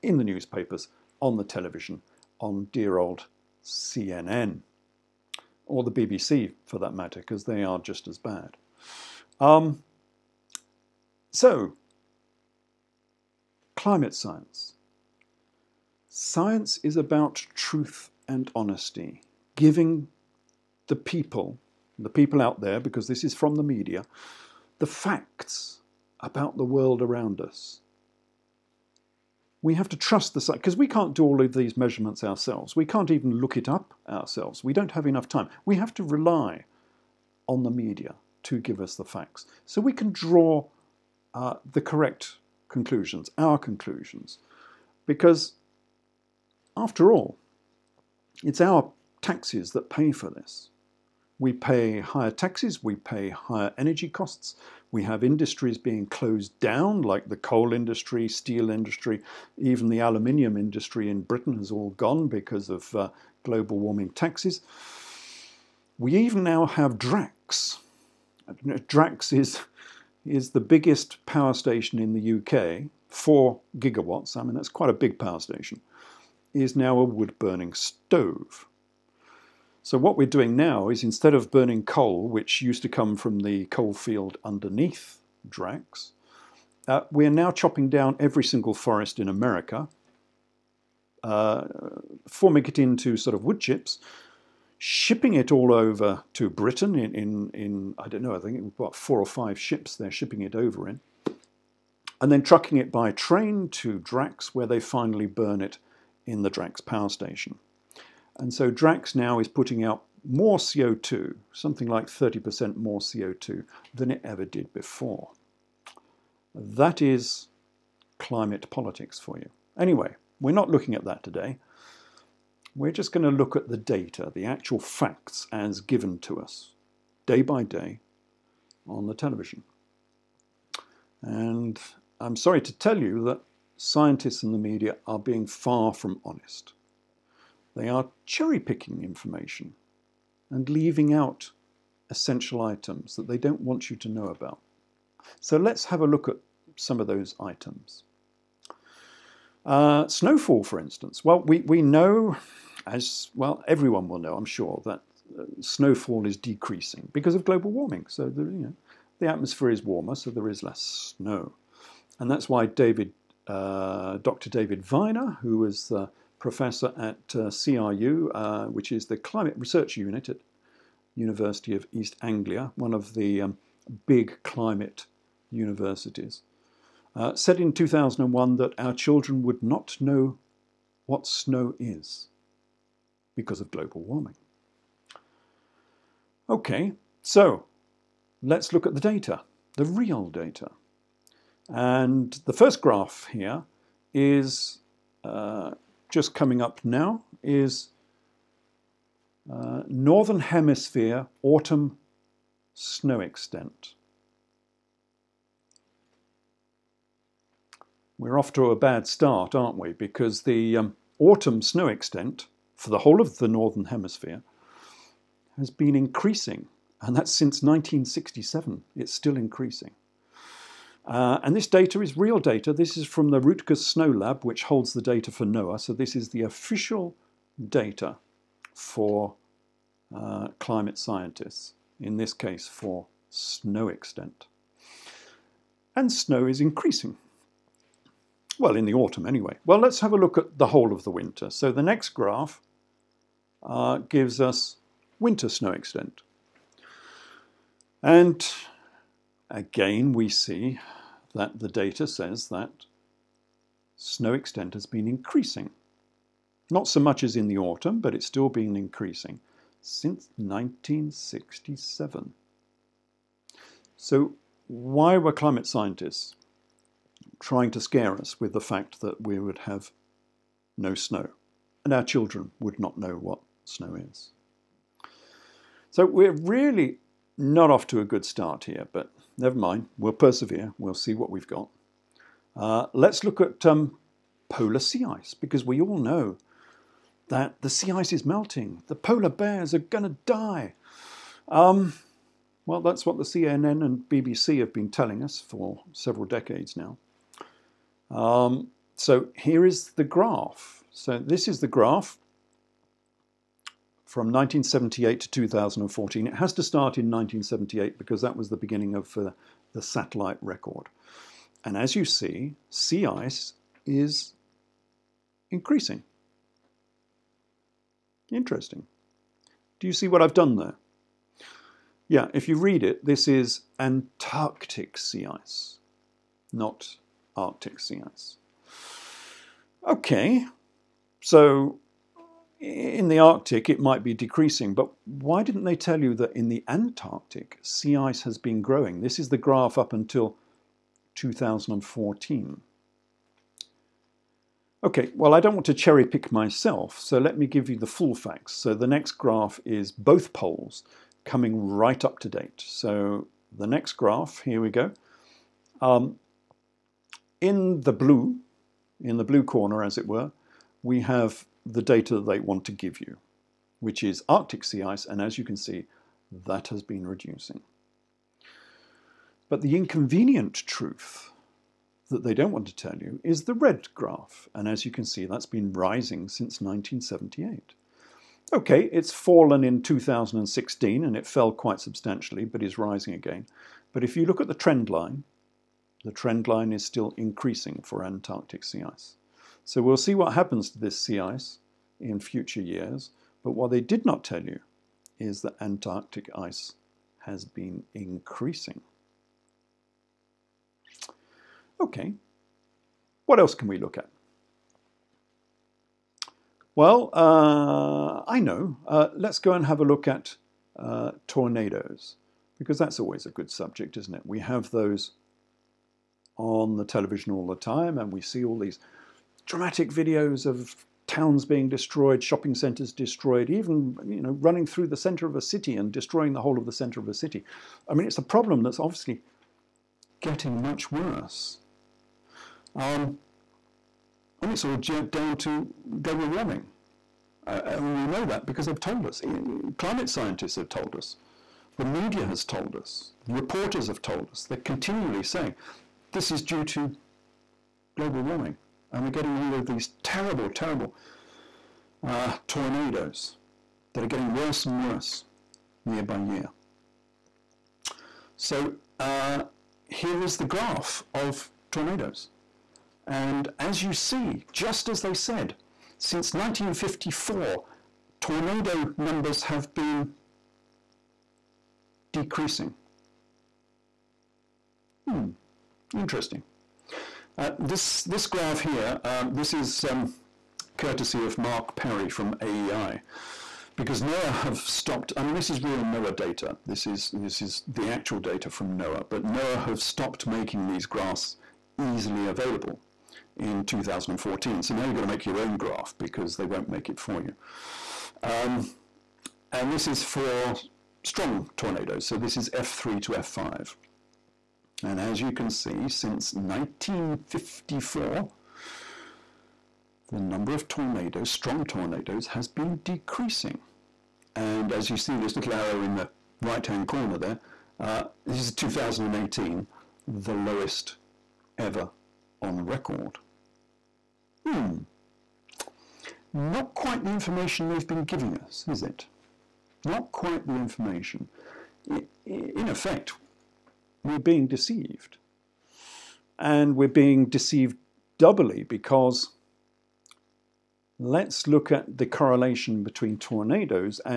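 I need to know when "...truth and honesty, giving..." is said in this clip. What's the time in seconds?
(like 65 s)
17 s.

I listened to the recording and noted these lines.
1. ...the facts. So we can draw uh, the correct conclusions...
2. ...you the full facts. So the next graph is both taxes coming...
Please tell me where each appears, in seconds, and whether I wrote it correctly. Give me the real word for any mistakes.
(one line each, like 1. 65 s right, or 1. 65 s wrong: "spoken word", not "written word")
1. 38 s right
2. 347 s wrong: "poles", not "taxes".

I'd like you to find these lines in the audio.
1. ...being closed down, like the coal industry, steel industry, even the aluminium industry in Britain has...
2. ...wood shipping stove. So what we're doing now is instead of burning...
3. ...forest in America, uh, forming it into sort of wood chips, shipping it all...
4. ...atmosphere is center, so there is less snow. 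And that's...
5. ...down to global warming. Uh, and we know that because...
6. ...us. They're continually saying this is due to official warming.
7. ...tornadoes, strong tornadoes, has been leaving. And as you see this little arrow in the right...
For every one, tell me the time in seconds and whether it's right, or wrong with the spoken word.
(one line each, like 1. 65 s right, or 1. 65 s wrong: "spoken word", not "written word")
1. 55 s right
2. 77 s wrong: "burning", not "shipping"
3. 88 s right
4. 159 s wrong: "warmer", not "center"
5. 434 s right
6. 444 s wrong: "global", not "official"
7. 510 s wrong: "decreasing", not "leaving".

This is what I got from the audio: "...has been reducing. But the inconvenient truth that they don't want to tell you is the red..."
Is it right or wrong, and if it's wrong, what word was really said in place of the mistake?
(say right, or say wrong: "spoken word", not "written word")
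right.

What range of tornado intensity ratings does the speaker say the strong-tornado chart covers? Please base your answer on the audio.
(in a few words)
F3 to F5.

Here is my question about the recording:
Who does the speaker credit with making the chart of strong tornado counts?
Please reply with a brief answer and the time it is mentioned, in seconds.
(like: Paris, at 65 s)
Mark Perry, at 481 s.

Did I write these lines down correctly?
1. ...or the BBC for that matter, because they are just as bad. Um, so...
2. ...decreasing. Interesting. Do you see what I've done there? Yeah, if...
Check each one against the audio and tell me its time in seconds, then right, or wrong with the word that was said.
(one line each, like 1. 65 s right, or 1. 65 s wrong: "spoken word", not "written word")
1. 5 s right
2. 315 s wrong: "increasing", not "decreasing".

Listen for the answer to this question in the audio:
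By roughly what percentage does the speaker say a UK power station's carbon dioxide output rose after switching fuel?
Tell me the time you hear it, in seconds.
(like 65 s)
112 s.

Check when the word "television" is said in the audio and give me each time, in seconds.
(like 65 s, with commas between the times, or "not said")
1 s, 129 s, 416 s.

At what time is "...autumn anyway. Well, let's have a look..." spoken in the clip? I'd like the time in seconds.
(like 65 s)
238 s.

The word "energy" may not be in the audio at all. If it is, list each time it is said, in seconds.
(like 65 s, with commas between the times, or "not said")
53 s.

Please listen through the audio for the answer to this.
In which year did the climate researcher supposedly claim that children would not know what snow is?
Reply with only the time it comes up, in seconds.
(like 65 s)
177 s.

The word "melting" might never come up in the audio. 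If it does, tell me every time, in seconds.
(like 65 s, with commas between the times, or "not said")
288 s.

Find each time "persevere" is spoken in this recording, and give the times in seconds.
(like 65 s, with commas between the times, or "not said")
280 s.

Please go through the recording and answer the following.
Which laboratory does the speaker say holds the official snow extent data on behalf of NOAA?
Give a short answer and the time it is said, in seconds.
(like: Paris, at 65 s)
Rutgers Snow Lab, at 223 s.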